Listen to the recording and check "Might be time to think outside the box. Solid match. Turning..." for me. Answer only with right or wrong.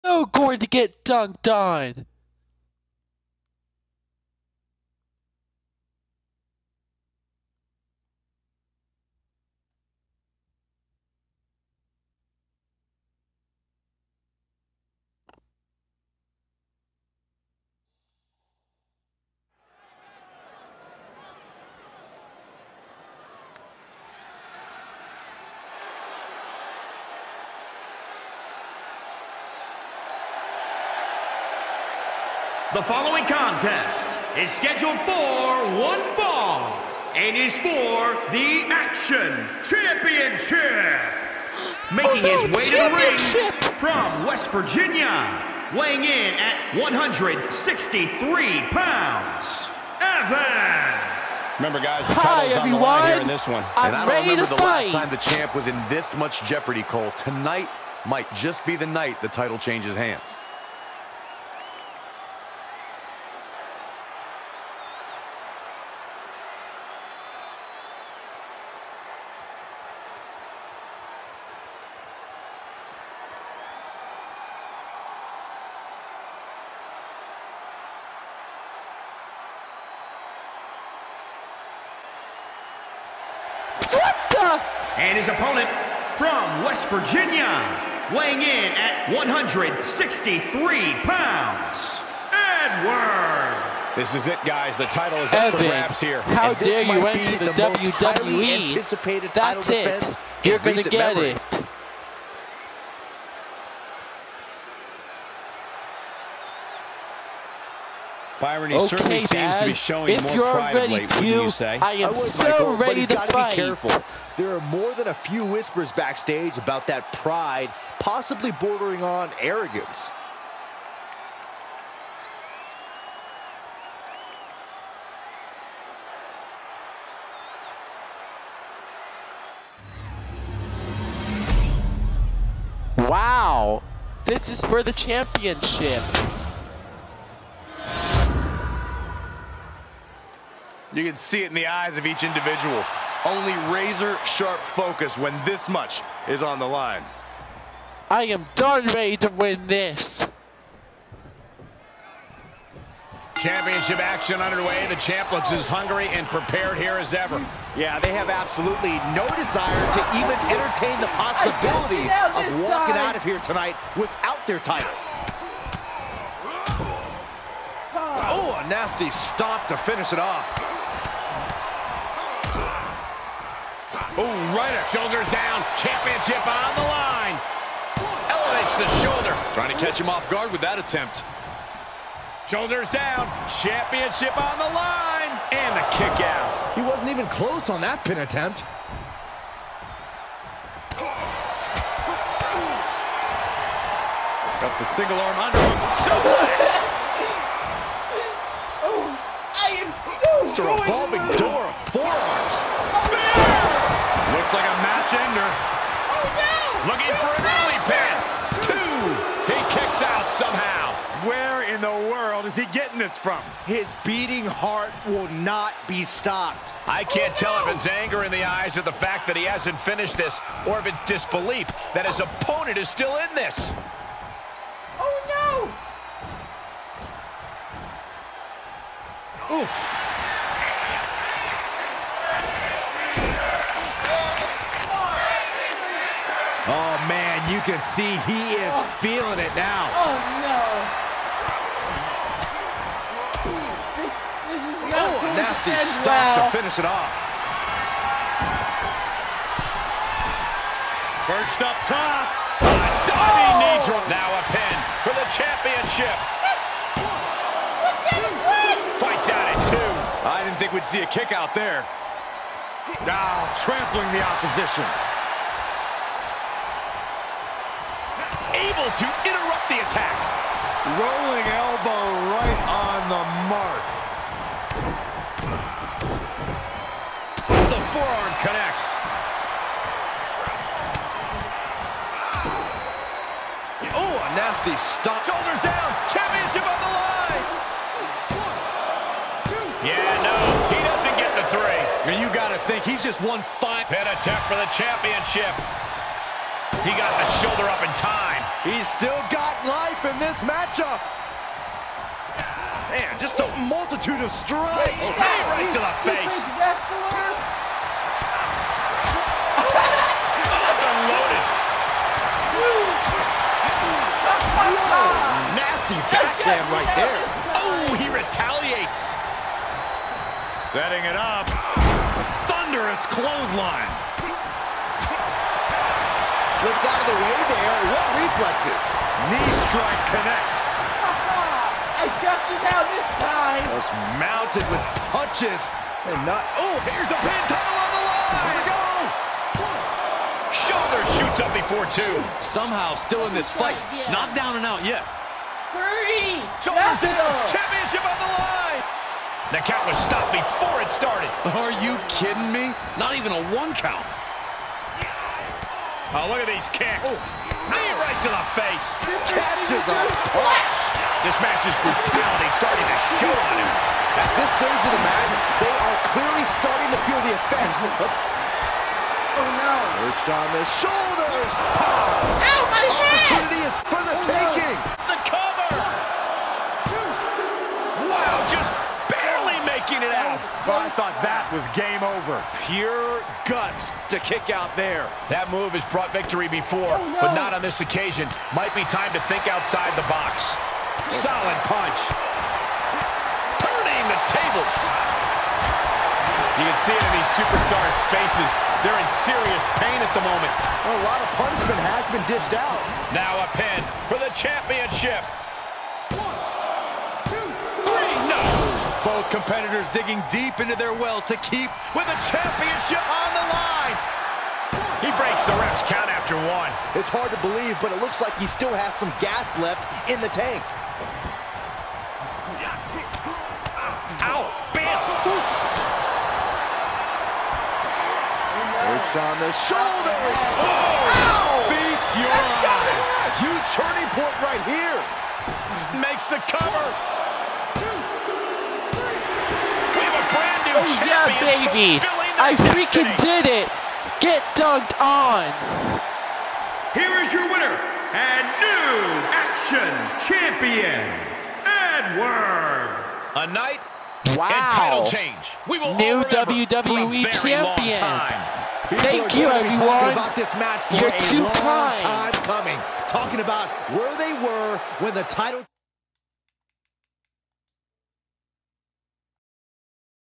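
wrong.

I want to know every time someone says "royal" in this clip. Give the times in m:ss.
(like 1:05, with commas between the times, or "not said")
not said.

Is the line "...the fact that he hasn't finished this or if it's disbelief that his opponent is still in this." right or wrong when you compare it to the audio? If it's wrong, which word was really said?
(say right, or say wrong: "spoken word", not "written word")
right.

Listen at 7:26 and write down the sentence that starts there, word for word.
Here is your winner and new action champion, Edward!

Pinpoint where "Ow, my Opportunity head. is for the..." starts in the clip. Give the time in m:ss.
6:11.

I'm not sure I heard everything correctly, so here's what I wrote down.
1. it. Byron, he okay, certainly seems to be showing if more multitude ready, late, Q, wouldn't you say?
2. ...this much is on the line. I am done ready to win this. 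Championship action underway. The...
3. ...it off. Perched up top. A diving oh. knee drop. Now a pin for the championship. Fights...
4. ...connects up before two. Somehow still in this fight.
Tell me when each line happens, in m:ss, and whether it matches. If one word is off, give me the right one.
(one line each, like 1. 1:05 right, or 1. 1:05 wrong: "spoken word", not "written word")
1. 1:41 wrong: "pride", not "multitude"
2. 2:25 right
3. 4:06 right
4. 5:41 wrong: "shoots", not "connects".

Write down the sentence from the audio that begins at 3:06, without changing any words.
He wasn't even close on that pin attempt.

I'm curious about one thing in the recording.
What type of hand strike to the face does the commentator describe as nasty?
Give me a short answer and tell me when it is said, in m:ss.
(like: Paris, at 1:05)
Backhand, at 5:16.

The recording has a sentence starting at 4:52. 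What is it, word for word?
And you got to think, he's just one five.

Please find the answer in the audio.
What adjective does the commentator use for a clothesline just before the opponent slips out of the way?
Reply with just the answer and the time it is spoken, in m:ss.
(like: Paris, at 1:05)
Thunderous, at 5:22.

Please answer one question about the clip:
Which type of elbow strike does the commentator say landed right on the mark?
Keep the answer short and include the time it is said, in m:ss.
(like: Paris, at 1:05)
Rolling elbow, at 4:30.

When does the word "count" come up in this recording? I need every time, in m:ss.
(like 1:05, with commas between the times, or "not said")
5:49, 5:53, 6:55.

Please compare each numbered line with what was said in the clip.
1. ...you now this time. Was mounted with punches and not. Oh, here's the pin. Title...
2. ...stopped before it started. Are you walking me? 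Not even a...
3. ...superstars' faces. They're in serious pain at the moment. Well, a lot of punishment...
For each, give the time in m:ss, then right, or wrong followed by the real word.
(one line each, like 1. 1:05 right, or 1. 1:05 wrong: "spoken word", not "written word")
1. 5:32 right
2. 5:49 wrong: "kidding", not "walking"
3. 6:37 right.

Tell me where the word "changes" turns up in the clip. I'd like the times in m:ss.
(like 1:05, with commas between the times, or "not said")
0:59, 7:35.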